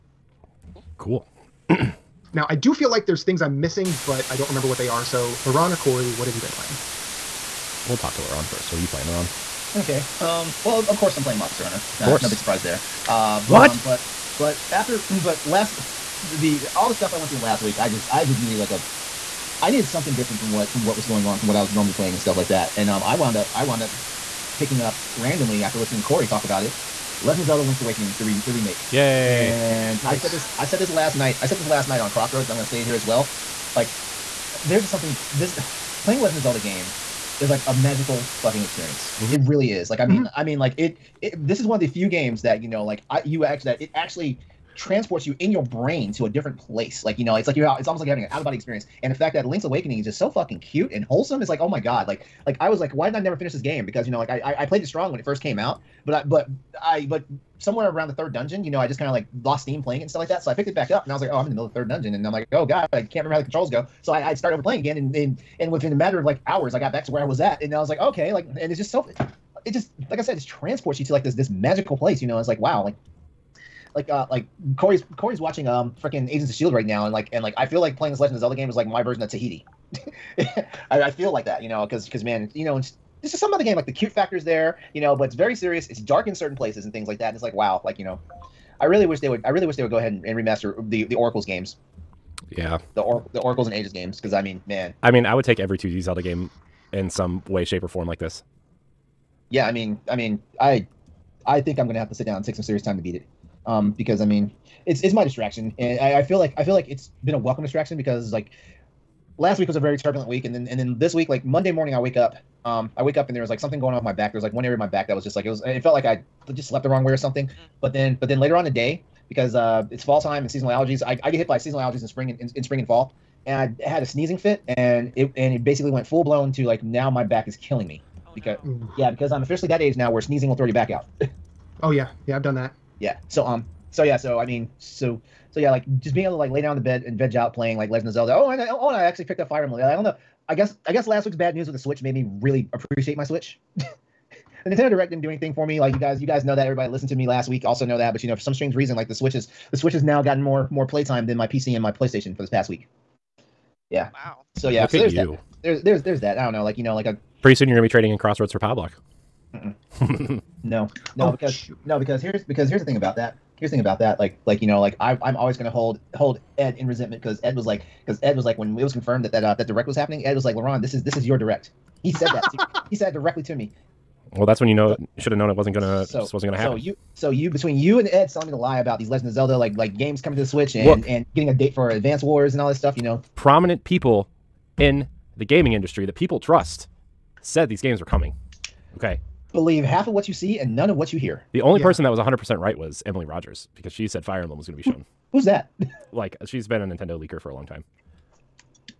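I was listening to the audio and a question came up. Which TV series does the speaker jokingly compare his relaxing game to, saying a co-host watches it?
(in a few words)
Agents of Shield.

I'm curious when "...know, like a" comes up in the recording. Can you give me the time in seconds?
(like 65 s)
156 s.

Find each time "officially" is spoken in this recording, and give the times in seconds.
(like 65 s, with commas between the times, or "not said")
129 s.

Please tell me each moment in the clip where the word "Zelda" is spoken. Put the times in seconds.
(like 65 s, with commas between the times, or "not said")
27 s, 36 s, 78 s, 96 s, 138 s, 179 s.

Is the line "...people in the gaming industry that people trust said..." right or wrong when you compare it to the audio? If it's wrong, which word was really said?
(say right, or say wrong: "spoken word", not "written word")
right.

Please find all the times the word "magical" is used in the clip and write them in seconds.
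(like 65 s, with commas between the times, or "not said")
37 s, 71 s.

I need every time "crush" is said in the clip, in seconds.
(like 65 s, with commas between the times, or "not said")
not said.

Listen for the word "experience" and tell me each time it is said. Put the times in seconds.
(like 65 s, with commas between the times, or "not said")
38 s, 48 s.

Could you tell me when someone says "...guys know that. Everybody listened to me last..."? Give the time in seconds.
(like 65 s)
146 s.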